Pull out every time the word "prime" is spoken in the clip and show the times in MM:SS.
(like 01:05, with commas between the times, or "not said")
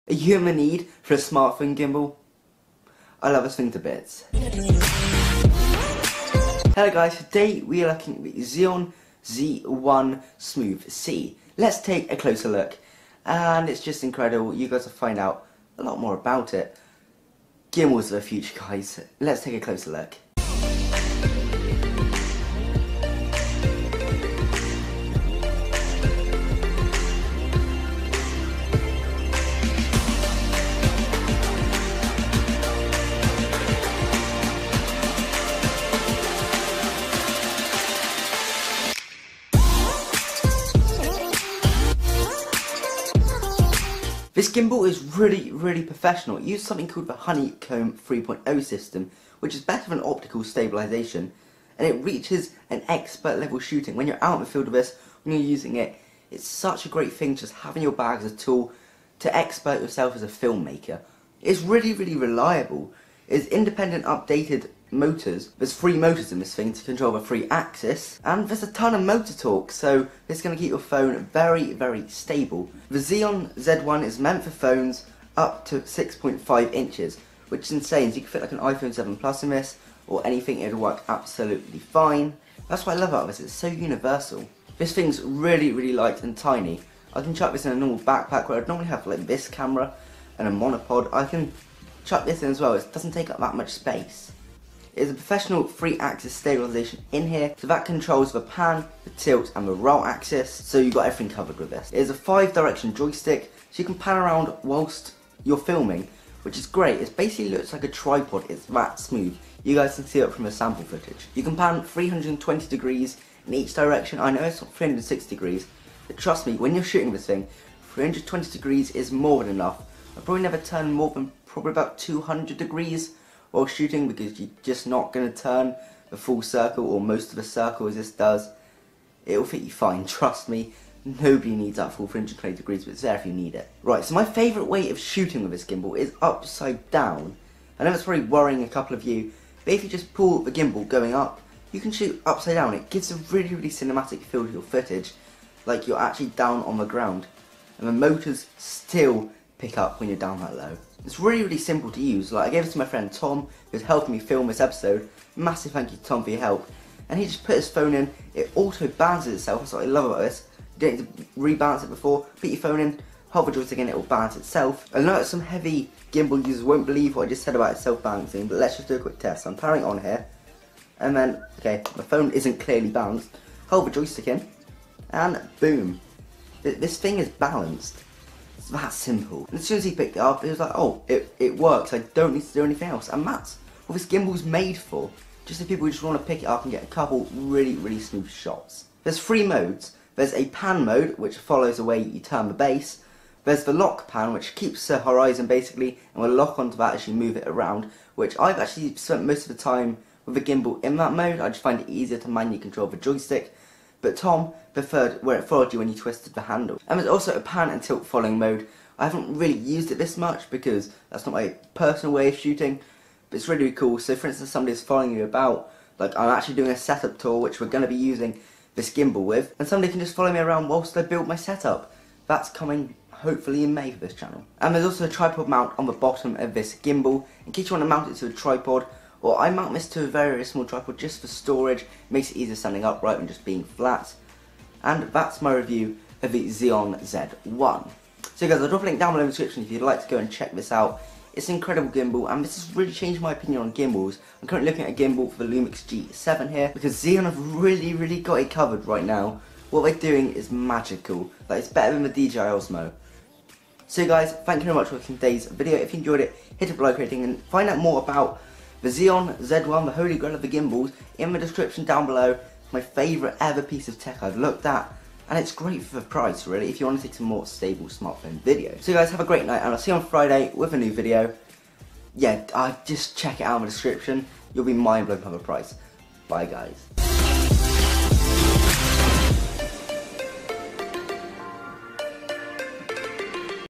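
not said.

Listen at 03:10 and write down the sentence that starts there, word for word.
There's a pan mode, which follows the way you turn the base.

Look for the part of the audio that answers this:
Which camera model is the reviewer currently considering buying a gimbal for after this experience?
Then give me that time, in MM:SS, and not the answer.
04:05.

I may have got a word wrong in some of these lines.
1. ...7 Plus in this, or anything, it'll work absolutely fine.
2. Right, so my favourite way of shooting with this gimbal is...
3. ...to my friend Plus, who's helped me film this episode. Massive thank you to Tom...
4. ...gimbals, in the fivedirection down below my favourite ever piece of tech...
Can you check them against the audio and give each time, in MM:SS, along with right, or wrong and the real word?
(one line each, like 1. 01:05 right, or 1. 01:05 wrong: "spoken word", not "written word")
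1. 01:18 right
2. 02:13 right
3. 02:32 wrong: "Tom", not "Plus"
4. 04:20 wrong: "description", not "fivedirection".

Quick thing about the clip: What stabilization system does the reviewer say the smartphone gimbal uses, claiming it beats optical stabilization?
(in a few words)
Honeycomb 3.0.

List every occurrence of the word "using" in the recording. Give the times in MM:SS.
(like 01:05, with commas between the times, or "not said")
00:55, 03:37.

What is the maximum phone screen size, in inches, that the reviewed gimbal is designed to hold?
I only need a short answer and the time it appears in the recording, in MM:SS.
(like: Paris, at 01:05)
6.5 inches, at 01:15.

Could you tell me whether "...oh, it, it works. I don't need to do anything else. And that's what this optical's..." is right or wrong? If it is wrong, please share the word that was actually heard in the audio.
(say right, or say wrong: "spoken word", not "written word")
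wrong: "gimbal", not "optical".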